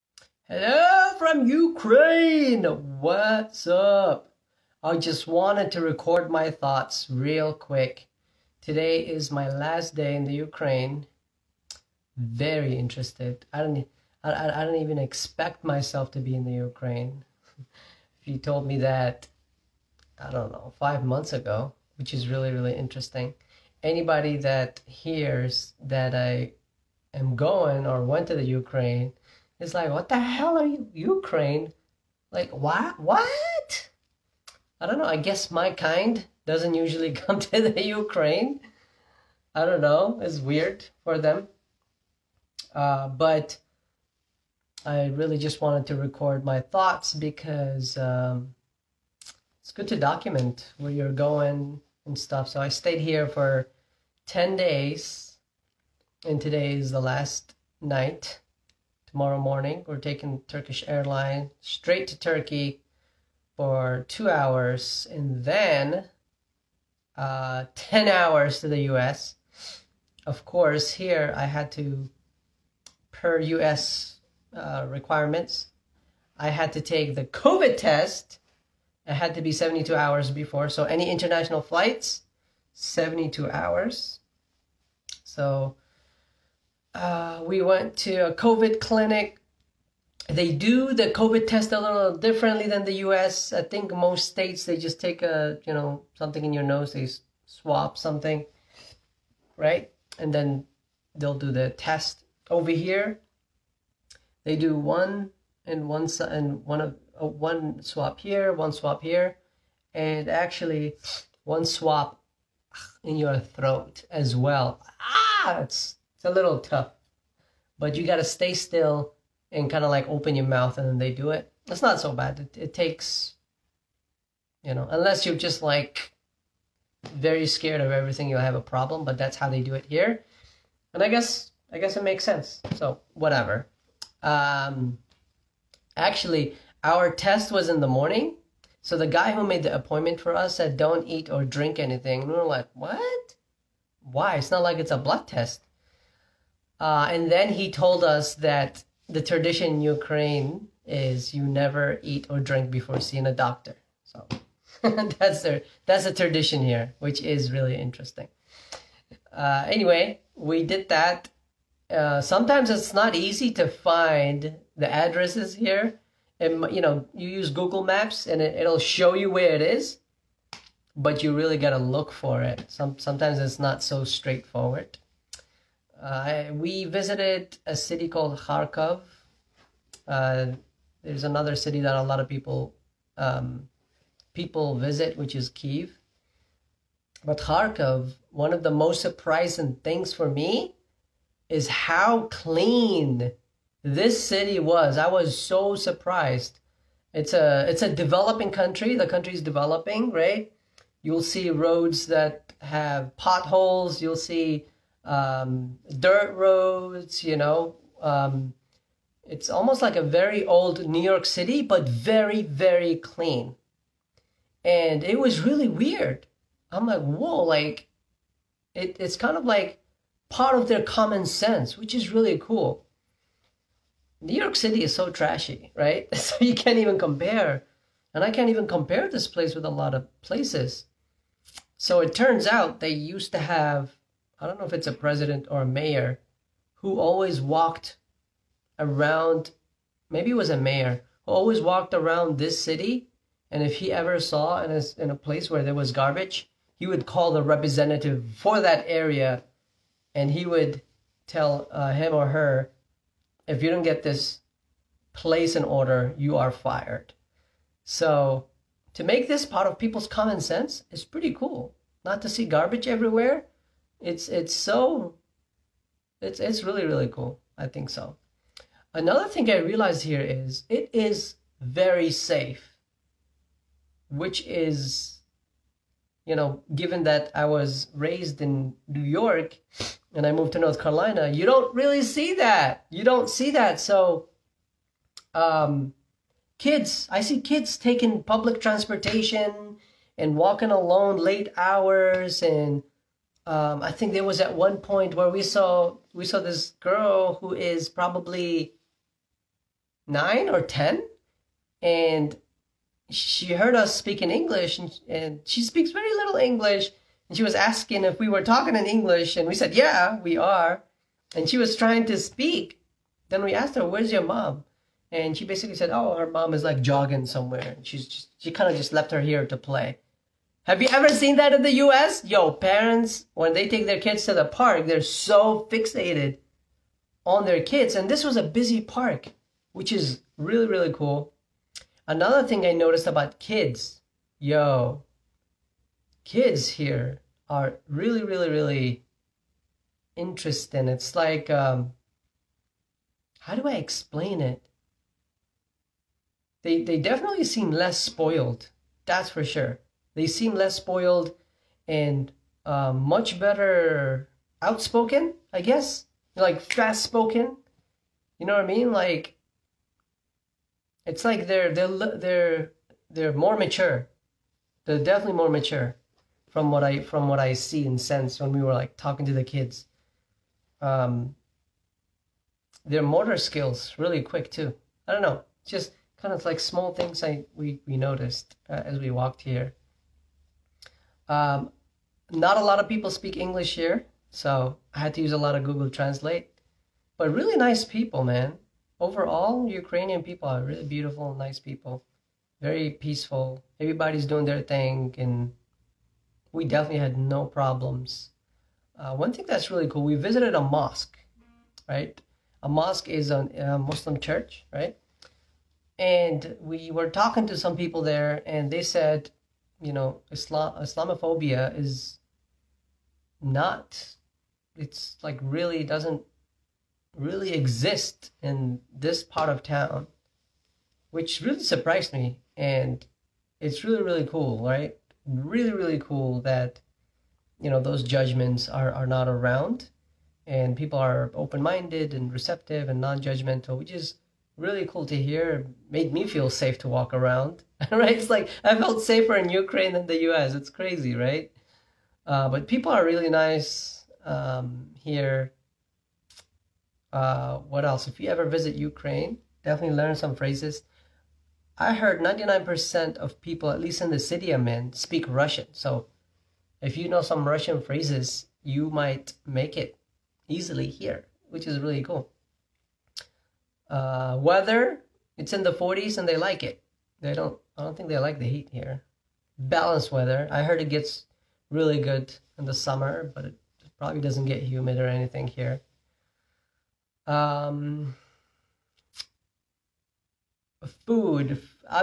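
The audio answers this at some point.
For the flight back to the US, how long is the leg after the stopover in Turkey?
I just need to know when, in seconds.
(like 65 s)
67 s.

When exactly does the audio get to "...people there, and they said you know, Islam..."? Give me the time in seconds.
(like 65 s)
407 s.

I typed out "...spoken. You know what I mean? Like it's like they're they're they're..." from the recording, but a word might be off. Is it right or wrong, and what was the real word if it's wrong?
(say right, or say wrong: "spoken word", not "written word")
right.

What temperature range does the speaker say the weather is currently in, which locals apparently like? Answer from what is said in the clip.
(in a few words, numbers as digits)
the 40s.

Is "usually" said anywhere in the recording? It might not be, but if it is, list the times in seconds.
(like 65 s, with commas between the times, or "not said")
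36 s.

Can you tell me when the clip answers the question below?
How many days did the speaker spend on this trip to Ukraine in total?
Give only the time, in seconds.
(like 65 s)
54 s.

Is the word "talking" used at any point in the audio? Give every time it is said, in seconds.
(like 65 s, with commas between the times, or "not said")
308 s, 368 s, 407 s.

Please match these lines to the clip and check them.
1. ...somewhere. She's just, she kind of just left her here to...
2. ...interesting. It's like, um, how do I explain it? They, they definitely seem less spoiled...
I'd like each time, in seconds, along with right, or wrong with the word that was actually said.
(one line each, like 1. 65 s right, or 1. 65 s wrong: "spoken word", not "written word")
1. 317 s right
2. 340 s right.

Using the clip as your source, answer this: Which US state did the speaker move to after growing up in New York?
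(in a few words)
North Carolina.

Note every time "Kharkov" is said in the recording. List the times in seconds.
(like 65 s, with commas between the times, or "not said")
178 s, 187 s.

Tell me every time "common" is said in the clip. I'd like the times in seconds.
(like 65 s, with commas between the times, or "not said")
220 s, 260 s.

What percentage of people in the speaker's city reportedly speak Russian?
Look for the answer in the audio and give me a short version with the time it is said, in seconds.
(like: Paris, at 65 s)
99%, at 452 s.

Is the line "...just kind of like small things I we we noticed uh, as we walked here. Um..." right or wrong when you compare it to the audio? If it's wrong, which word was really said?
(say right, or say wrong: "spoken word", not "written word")
right.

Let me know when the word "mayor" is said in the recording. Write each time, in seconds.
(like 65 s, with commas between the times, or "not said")
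235 s, 240 s.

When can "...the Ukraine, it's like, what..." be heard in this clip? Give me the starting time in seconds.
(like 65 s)
28 s.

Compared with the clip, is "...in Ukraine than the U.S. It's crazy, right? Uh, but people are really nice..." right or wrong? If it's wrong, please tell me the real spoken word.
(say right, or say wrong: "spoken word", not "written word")
right.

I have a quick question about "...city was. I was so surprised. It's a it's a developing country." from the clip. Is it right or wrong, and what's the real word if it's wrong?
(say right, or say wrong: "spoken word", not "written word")
right.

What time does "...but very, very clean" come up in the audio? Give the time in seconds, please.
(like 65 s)
211 s.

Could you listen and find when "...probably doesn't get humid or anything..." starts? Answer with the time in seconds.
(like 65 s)
473 s.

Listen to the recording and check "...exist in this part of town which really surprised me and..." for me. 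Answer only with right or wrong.
right.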